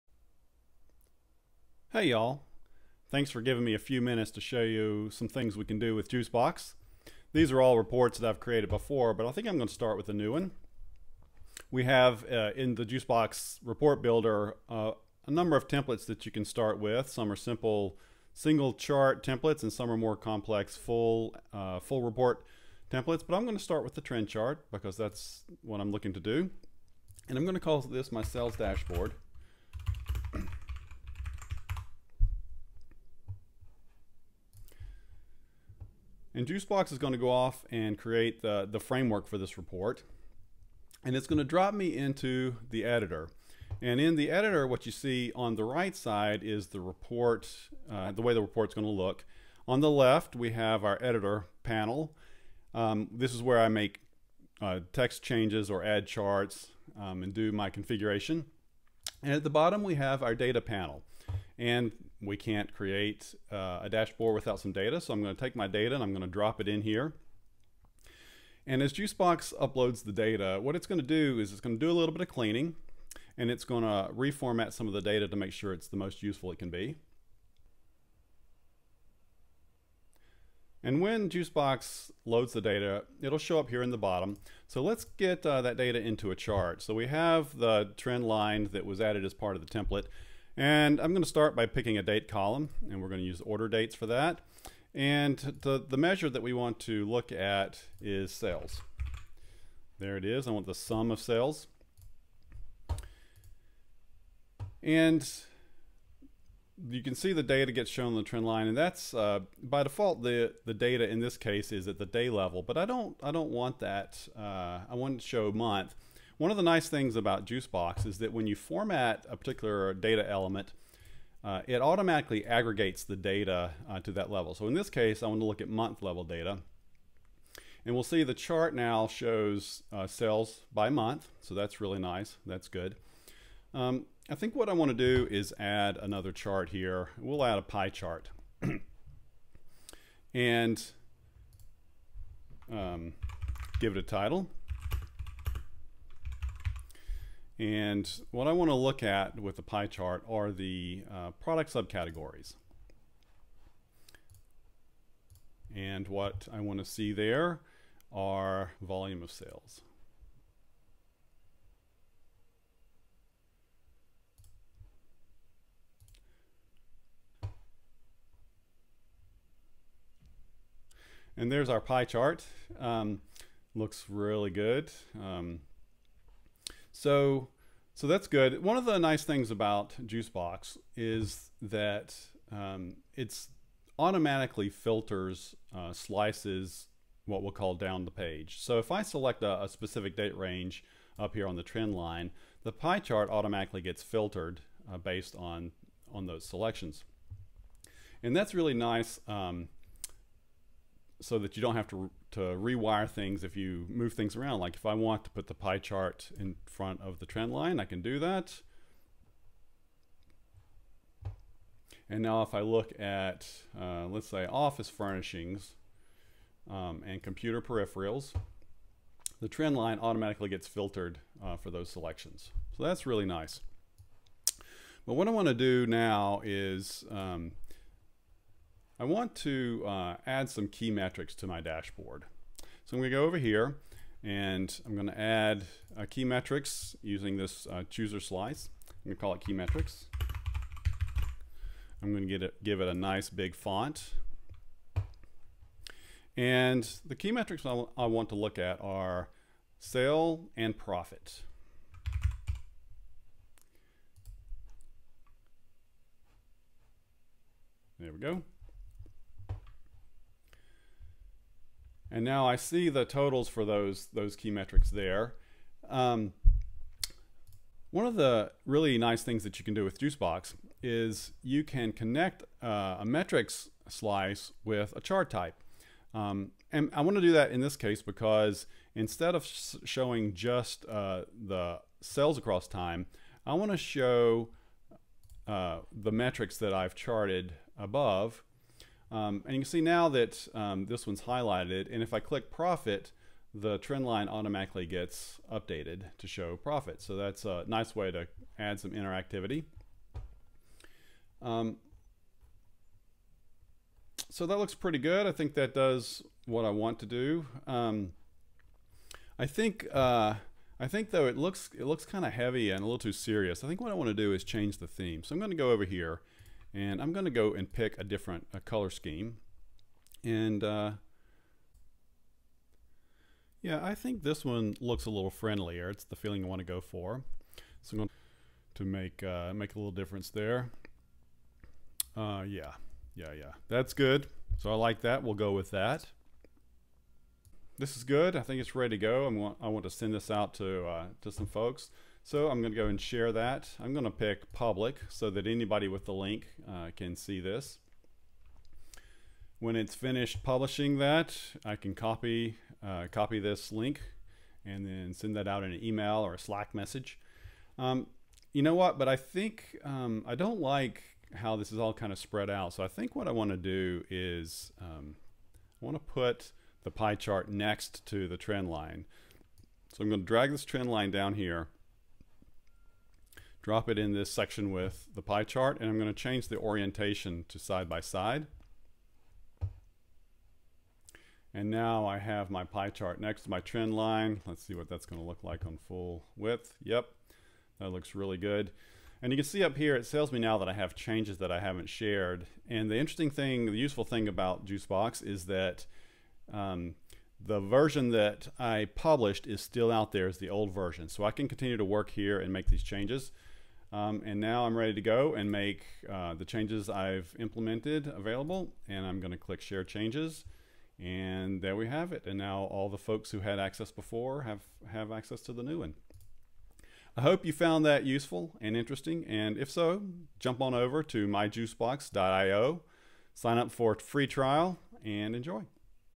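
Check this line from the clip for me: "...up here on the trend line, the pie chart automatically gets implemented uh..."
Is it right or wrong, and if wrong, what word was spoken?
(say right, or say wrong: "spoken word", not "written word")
wrong: "filtered", not "implemented".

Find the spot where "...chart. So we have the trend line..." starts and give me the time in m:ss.
1:26.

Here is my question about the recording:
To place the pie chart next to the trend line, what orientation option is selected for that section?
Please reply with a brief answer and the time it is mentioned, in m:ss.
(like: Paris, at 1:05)
side by side, at 6:17.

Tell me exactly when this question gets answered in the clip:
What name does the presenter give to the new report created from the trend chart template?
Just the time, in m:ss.
0:28.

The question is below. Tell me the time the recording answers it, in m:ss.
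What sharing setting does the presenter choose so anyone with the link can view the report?
5:44.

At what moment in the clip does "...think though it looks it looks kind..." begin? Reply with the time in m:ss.
5:10.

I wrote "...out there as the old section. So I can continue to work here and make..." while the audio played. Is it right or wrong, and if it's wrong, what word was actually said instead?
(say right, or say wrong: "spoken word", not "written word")
wrong: "version", not "section".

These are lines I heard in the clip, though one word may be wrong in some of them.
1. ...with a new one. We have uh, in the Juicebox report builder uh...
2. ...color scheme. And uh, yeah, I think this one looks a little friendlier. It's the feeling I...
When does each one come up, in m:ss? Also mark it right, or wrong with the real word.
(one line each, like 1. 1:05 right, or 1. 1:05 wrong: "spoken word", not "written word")
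1. 0:09 right
2. 5:18 right.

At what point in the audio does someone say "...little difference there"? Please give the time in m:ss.
5:29.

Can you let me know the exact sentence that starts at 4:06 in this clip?
And the key metrics I, I want to look at are sale and profit.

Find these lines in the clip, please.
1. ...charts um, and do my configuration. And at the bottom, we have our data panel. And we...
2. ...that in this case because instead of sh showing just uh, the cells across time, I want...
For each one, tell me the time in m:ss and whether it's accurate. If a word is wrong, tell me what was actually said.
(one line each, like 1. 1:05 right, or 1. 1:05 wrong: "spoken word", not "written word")
1. 0:56 right
2. 4:37 right.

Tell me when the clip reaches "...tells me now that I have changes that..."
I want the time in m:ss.
6:30.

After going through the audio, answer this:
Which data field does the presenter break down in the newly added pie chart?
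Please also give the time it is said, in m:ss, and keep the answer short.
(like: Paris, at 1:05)
product subcategories, at 2:31.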